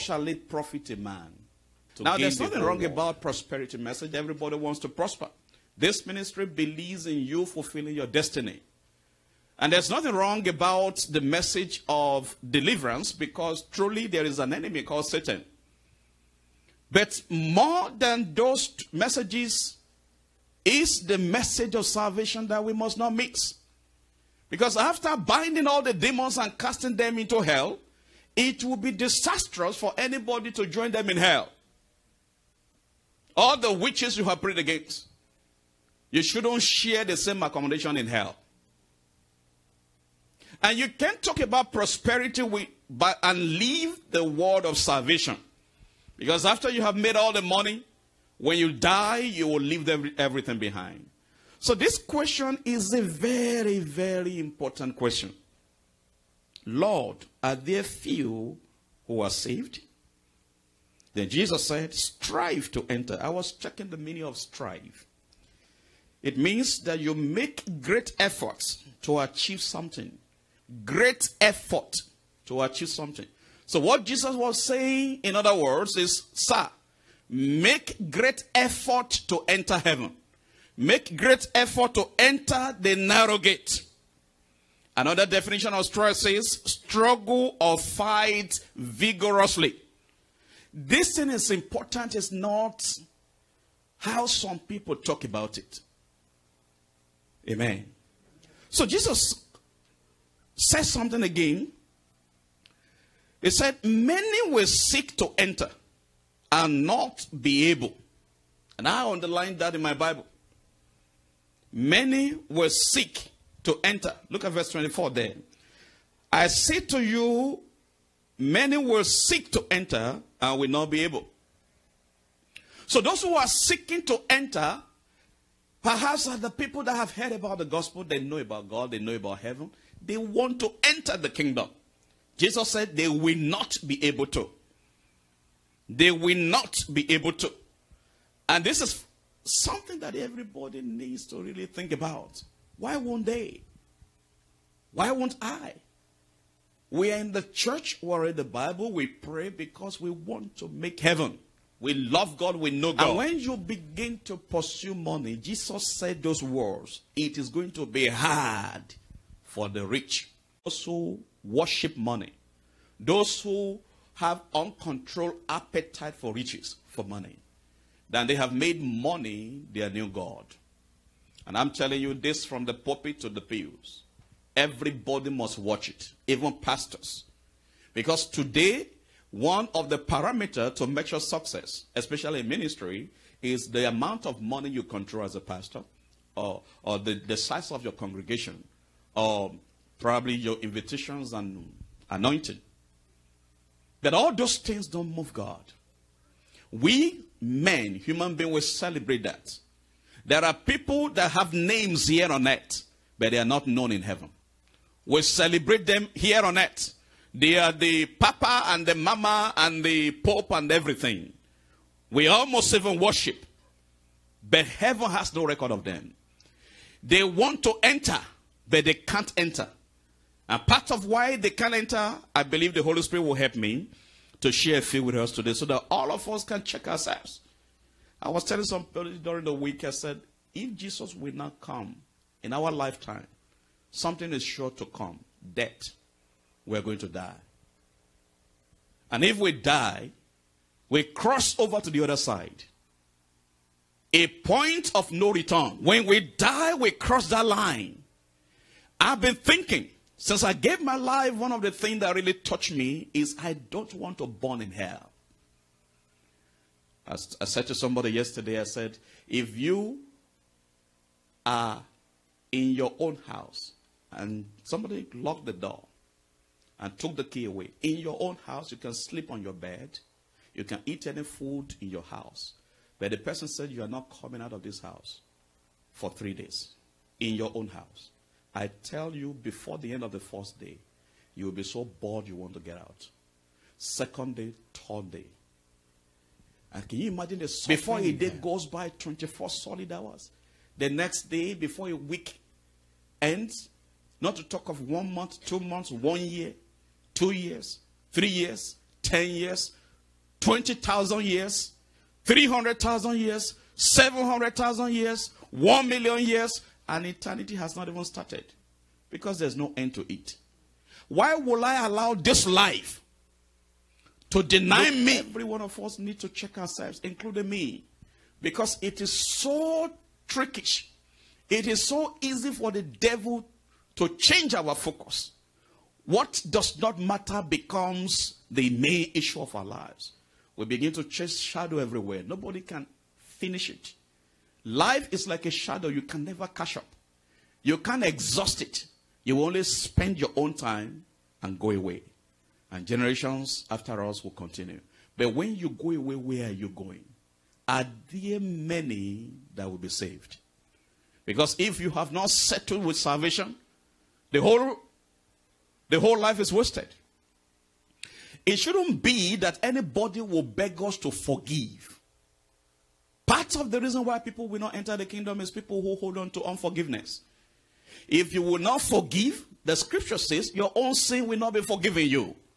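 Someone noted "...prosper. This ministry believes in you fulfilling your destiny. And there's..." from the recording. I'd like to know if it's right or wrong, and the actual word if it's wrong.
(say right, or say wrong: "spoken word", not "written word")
right.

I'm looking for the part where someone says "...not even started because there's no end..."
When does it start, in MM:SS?
05:07.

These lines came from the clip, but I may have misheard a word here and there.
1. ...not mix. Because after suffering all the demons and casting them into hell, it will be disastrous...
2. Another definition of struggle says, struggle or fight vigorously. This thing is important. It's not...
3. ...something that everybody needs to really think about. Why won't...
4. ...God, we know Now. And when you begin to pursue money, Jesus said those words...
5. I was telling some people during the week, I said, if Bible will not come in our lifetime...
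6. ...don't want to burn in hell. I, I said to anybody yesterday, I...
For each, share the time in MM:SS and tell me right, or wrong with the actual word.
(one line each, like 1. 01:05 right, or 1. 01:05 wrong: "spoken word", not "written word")
1. 00:22 wrong: "binding", not "suffering"
2. 01:24 right
3. 02:19 right
4. 02:32 wrong: "God", not "Now"
5. 03:48 wrong: "Jesus", not "Bible"
6. 04:13 wrong: "somebody", not "anybody".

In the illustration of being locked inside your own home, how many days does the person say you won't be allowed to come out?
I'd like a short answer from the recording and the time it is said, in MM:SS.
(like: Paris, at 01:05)
3 days, at 04:36.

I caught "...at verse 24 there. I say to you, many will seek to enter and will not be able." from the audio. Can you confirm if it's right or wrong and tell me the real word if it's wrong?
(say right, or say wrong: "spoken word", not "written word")
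right.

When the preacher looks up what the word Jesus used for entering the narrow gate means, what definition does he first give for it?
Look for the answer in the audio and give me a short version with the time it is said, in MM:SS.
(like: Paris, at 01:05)
make great efforts to achieve something, at 01:07.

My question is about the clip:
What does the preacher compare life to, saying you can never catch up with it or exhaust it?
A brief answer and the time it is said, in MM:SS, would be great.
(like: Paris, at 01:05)
a shadow, at 05:35.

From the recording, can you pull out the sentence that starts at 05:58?
It shouldn't be that anybody will beg us to forgive.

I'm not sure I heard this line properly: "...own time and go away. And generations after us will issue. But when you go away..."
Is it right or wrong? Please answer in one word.
wrong.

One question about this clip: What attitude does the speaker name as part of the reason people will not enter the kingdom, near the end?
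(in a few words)
unforgiveness.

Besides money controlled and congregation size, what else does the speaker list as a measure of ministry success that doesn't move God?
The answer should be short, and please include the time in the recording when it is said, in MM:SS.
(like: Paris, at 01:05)
invitations and anointing, at 03:10.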